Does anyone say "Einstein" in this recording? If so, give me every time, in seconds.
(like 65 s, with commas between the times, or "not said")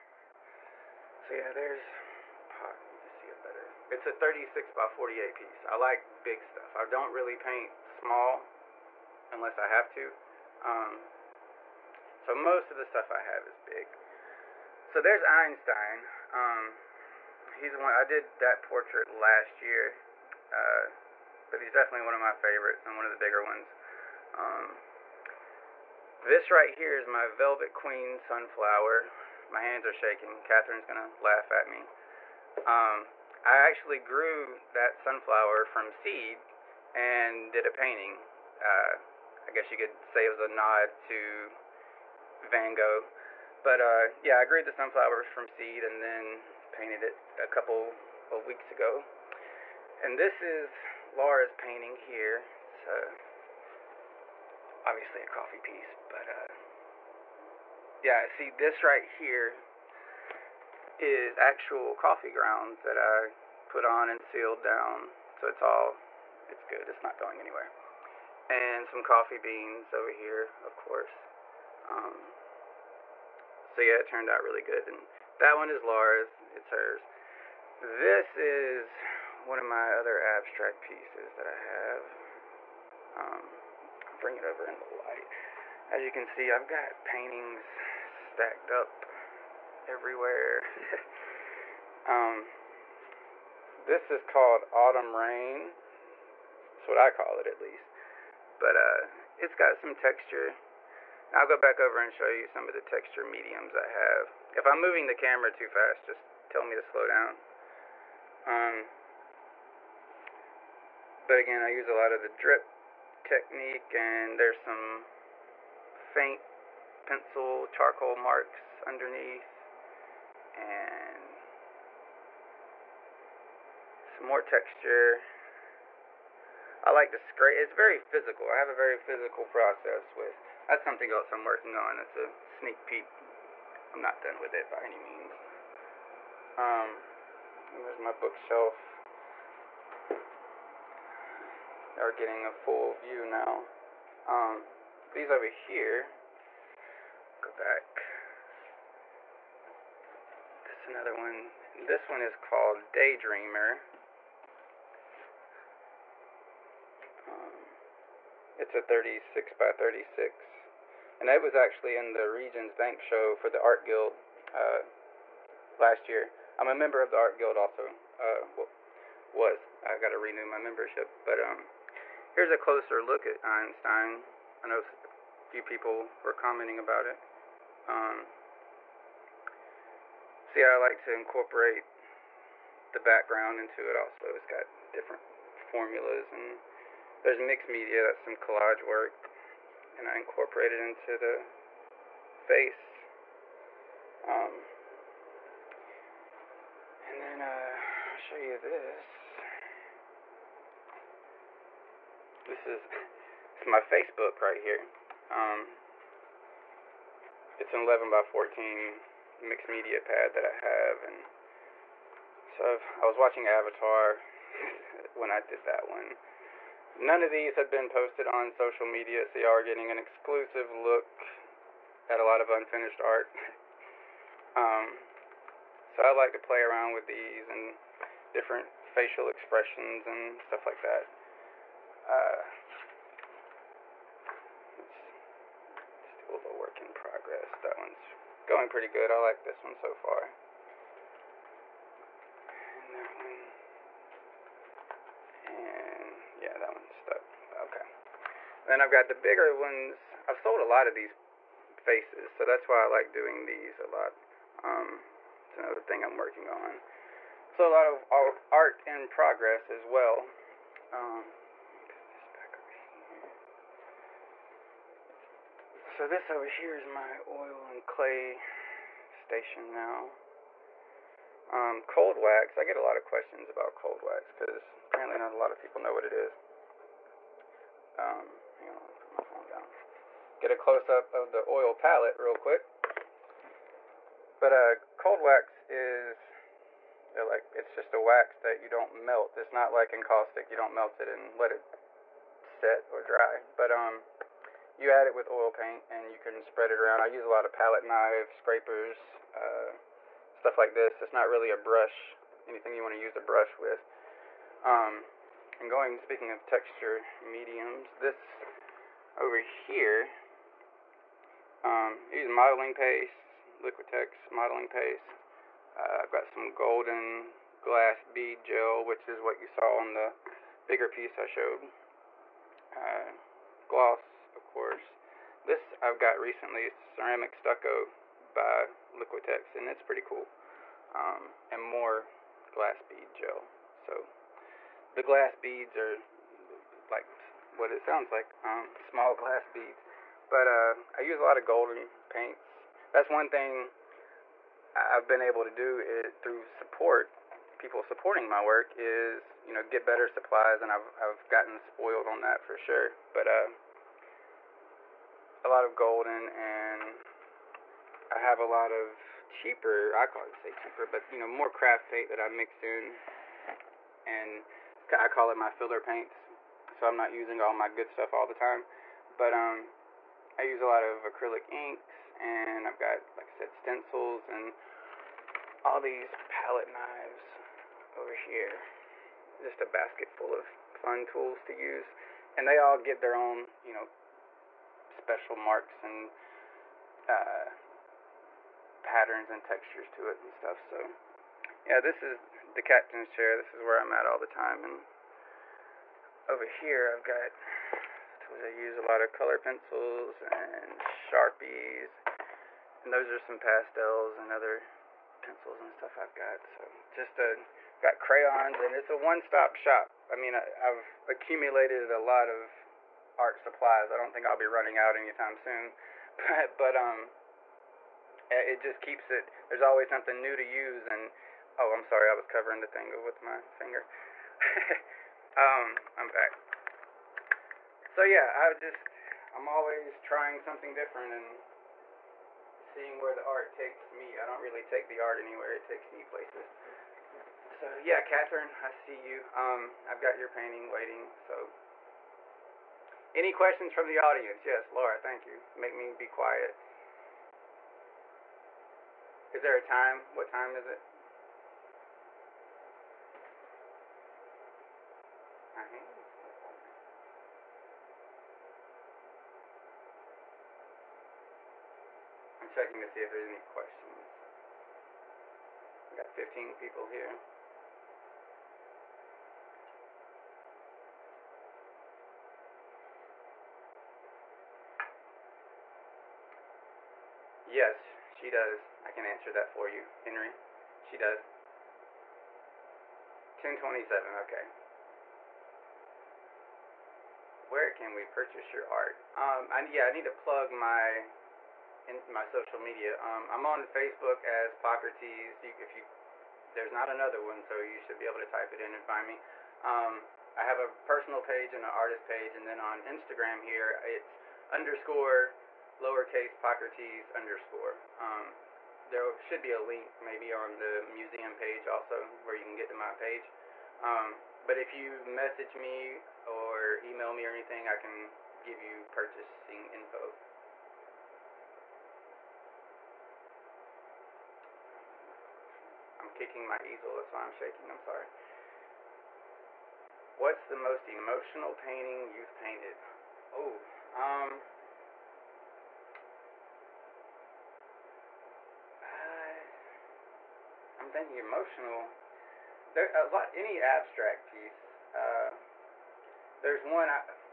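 15 s, 173 s.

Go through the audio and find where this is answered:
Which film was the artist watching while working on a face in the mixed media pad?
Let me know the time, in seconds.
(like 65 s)
213 s.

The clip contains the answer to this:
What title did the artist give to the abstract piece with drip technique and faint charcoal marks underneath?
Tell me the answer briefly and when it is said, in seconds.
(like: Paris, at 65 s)
Autumn Rain, at 94 s.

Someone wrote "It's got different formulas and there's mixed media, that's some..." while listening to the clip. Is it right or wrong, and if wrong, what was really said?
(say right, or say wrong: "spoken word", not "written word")
right.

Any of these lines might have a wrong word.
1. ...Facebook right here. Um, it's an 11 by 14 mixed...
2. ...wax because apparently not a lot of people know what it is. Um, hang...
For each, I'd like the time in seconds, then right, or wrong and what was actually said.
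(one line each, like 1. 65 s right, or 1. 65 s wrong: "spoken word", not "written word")
1. 203 s right
2. 274 s right.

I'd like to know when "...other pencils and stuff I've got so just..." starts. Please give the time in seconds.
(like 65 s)
404 s.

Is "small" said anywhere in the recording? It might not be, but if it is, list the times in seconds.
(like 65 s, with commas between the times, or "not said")
7 s, 338 s.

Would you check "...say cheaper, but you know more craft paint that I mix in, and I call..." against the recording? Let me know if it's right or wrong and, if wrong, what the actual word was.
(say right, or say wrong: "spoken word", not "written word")
right.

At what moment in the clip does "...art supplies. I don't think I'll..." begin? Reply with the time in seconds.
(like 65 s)
413 s.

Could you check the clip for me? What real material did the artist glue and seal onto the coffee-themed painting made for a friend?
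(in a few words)
coffee grounds.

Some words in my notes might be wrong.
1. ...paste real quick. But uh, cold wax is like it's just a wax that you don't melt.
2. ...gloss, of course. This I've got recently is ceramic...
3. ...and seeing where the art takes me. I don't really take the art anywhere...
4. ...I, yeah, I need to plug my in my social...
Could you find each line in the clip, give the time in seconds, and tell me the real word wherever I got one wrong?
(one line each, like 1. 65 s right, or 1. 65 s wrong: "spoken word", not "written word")
1. 281 s wrong: "palette", not "paste"
2. 323 s right
3. 431 s right
4. 489 s right.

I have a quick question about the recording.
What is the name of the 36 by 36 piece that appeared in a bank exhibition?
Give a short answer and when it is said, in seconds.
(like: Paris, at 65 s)
Daydreamer, at 152 s.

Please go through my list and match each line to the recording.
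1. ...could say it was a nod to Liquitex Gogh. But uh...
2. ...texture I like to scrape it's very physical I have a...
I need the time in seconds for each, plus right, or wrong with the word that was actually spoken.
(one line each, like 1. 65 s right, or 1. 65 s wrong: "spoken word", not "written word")
1. 39 s wrong: "Van", not "Liquitex"
2. 124 s right.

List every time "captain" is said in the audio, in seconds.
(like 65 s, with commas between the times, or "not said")
392 s.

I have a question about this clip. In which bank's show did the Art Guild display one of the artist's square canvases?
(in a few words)
Regions Bank.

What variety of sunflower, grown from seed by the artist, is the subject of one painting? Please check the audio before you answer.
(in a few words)
Velvet Queen.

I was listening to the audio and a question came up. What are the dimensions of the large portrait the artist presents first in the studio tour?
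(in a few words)
36 by 48.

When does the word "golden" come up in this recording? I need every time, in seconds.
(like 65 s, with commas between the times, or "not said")
316 s, 341 s, 355 s.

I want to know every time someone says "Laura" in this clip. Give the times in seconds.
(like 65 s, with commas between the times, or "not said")
51 s, 75 s, 444 s.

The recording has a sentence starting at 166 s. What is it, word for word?
I'm a member of the Art Guild also.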